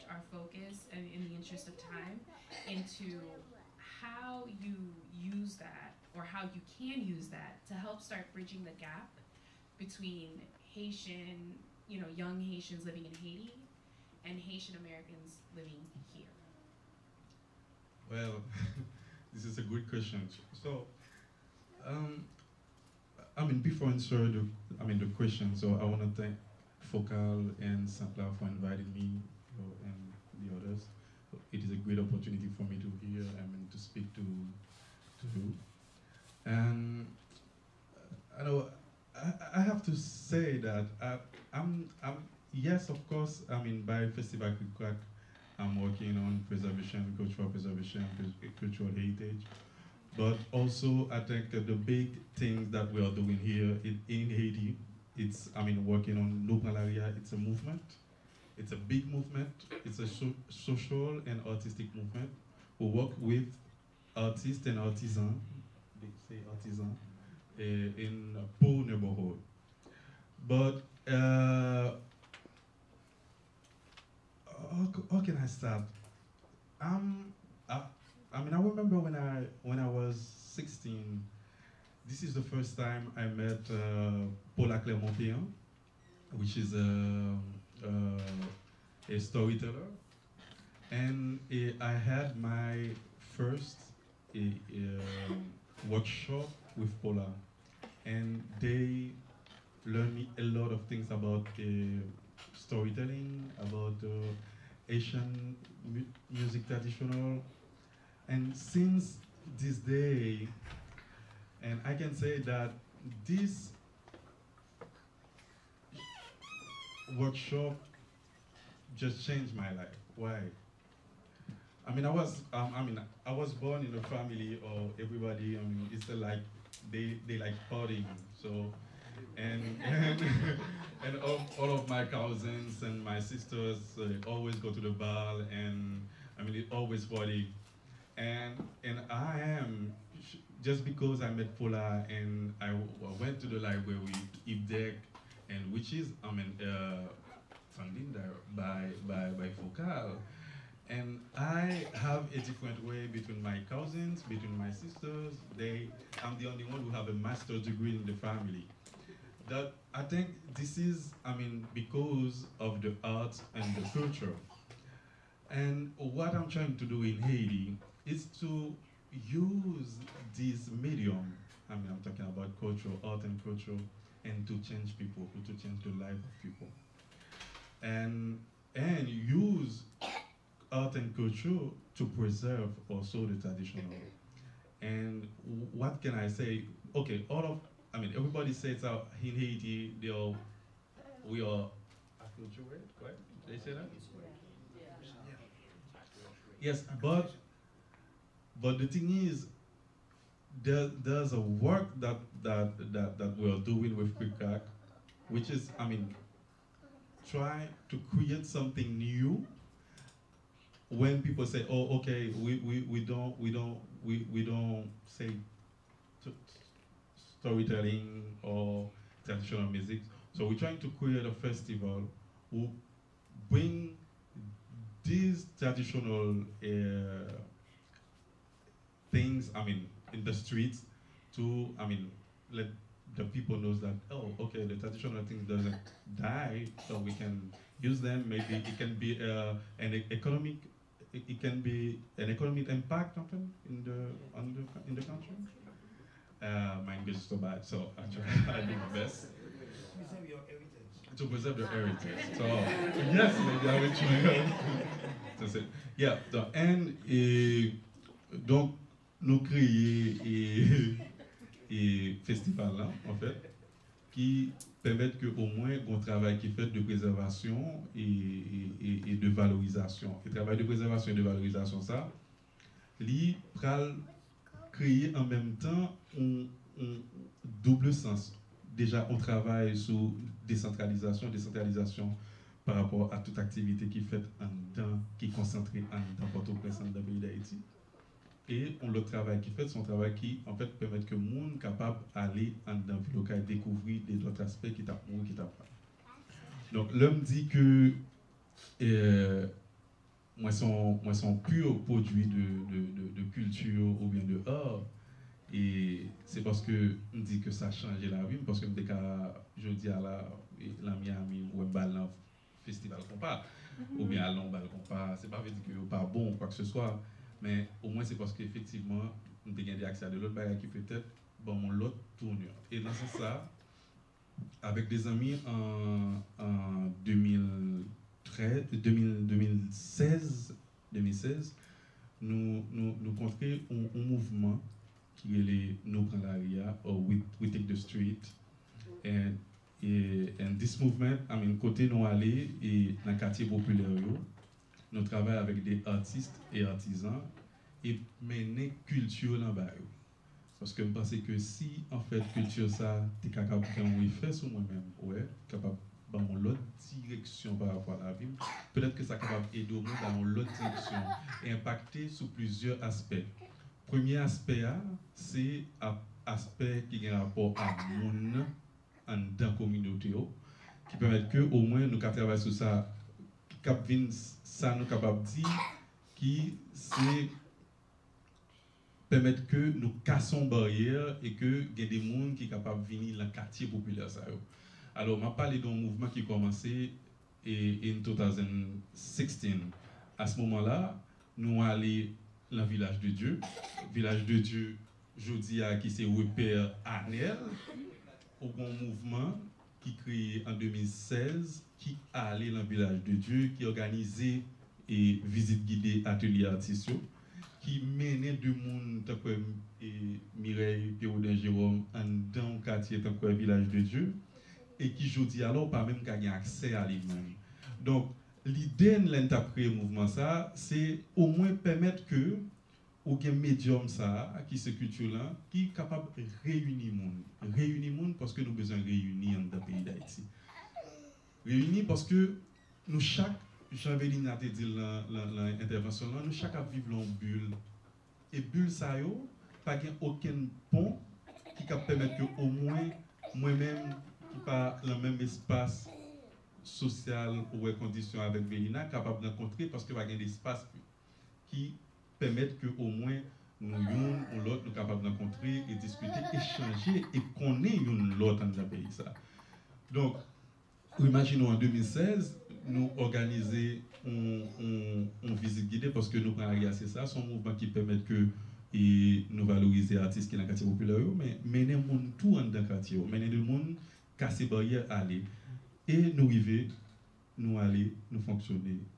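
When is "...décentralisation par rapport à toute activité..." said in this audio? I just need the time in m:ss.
4:41.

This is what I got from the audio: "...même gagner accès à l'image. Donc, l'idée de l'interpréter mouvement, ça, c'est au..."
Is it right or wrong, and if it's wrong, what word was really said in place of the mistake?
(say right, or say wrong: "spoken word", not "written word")
right.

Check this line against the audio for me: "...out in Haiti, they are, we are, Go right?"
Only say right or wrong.
right.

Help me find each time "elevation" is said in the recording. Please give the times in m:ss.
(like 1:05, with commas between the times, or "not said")
not said.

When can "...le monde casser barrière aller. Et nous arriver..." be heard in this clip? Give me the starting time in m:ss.
7:53.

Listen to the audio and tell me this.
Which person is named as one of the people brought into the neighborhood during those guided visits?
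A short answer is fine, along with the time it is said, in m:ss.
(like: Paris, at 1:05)
Mireille Pierre Jérôme, at 6:50.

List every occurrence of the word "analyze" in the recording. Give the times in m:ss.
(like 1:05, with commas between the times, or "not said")
not said.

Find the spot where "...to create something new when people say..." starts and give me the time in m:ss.
3:27.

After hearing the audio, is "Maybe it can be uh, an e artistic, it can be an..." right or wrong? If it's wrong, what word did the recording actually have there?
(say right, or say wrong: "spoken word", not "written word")
wrong: "economic", not "artistic".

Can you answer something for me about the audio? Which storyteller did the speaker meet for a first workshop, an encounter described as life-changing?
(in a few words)
Paula Clermont-Péan.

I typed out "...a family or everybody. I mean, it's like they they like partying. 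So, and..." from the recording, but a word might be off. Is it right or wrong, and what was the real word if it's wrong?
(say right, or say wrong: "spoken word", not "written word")
right.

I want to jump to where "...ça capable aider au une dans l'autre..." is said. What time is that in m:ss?
5:59.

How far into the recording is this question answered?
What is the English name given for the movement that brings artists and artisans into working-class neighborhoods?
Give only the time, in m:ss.
5:37.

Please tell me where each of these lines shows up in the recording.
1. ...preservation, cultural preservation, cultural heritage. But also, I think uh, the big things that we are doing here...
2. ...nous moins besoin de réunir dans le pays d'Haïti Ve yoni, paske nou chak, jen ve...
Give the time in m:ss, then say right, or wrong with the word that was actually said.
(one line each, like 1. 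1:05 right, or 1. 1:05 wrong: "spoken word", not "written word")
1. 0:46 right
2. 7:08 wrong: "avons", not "moins".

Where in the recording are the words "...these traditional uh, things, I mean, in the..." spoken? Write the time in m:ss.
3:45.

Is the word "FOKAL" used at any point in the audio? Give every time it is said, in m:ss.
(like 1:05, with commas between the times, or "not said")
0:26, 2:29.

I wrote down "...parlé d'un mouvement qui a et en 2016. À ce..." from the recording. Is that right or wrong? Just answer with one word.
right.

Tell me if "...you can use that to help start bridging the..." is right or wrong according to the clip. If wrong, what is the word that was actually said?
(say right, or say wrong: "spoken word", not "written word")
right.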